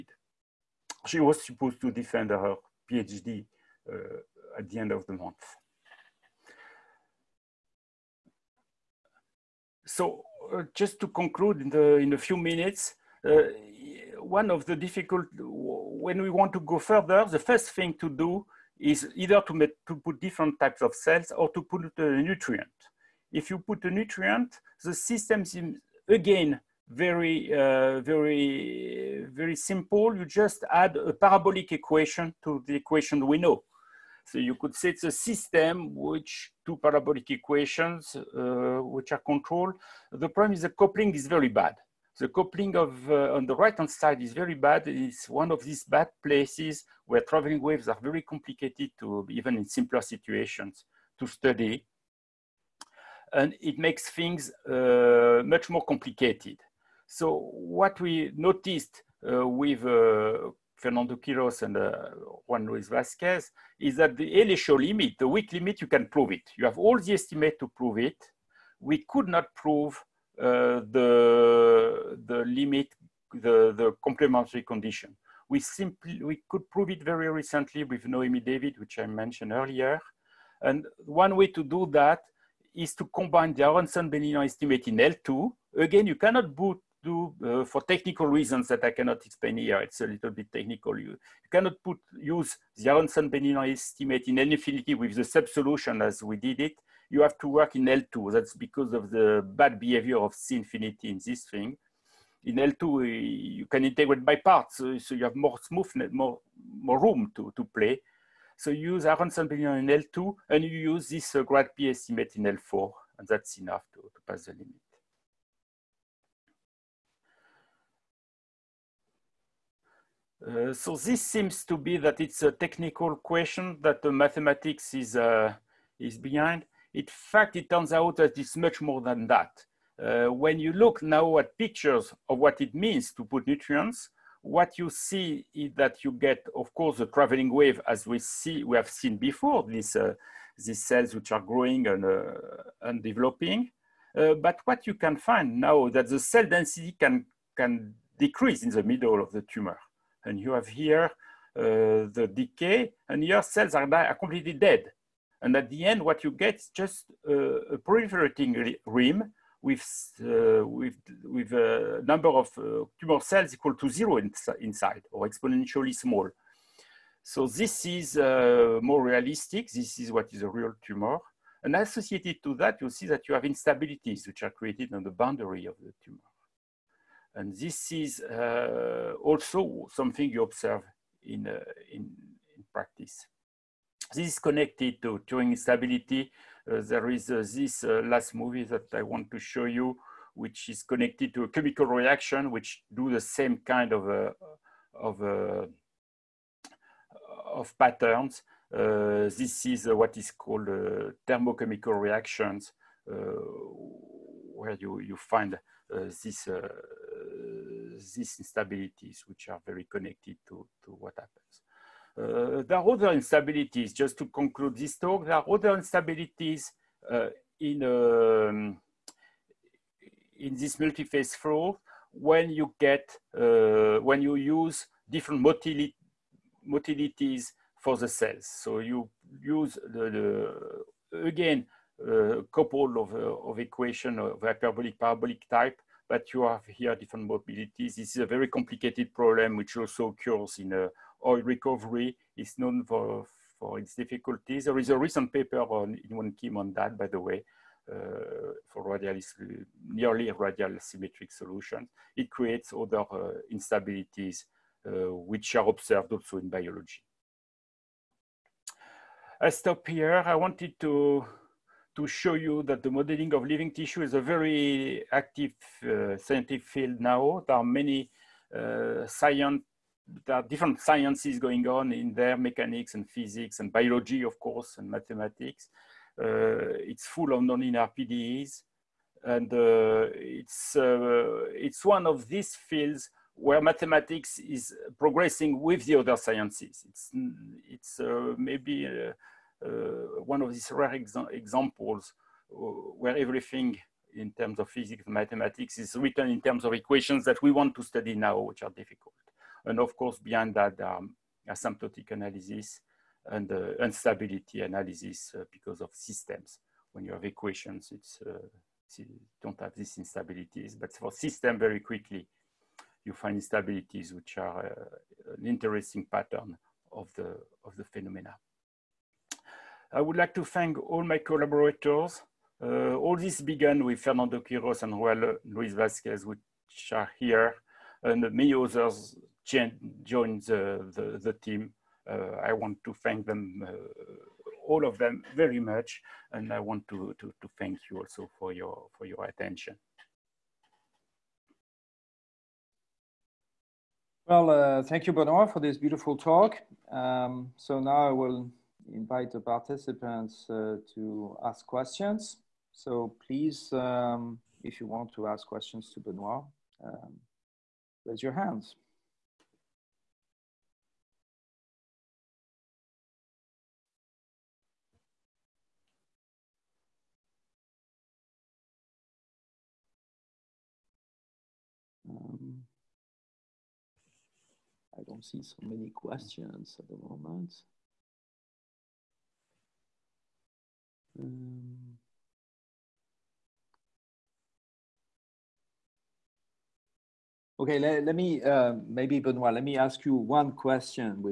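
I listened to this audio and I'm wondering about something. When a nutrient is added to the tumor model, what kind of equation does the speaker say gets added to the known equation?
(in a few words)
parabolic equation.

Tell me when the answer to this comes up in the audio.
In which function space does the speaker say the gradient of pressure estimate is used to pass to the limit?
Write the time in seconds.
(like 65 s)
112 s.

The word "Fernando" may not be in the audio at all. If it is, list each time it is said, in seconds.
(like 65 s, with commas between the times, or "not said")
60 s, 323 s.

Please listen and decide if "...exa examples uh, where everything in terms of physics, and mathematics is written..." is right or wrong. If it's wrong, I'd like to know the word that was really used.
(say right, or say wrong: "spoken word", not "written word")
right.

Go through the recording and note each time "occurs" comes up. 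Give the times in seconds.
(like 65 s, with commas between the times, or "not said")
240 s.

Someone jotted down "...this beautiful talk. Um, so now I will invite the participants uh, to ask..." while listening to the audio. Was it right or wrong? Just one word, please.
right.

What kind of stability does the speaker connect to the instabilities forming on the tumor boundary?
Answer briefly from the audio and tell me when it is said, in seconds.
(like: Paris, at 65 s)
Turing stability, at 185 s.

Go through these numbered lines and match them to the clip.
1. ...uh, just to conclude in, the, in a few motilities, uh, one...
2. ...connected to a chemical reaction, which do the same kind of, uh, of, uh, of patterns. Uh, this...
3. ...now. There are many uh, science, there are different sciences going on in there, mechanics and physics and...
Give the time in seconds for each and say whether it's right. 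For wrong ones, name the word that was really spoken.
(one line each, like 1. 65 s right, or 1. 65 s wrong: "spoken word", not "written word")
1. 10 s wrong: "minutes", not "motilities"
2. 190 s right
3. 266 s right.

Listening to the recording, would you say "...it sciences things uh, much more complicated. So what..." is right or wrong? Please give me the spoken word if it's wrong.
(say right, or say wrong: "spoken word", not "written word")
wrong: "makes", not "sciences".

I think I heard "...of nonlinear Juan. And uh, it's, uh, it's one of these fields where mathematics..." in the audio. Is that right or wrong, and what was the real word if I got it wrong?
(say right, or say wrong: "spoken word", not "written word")
wrong: "PDEs", not "Juan".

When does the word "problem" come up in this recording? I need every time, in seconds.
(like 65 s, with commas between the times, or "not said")
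40 s, 239 s.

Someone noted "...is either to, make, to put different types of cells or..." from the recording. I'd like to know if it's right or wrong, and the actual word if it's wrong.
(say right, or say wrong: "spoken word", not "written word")
right.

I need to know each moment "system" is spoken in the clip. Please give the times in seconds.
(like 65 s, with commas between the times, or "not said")
24 s, 35 s, 305 s, 311 s.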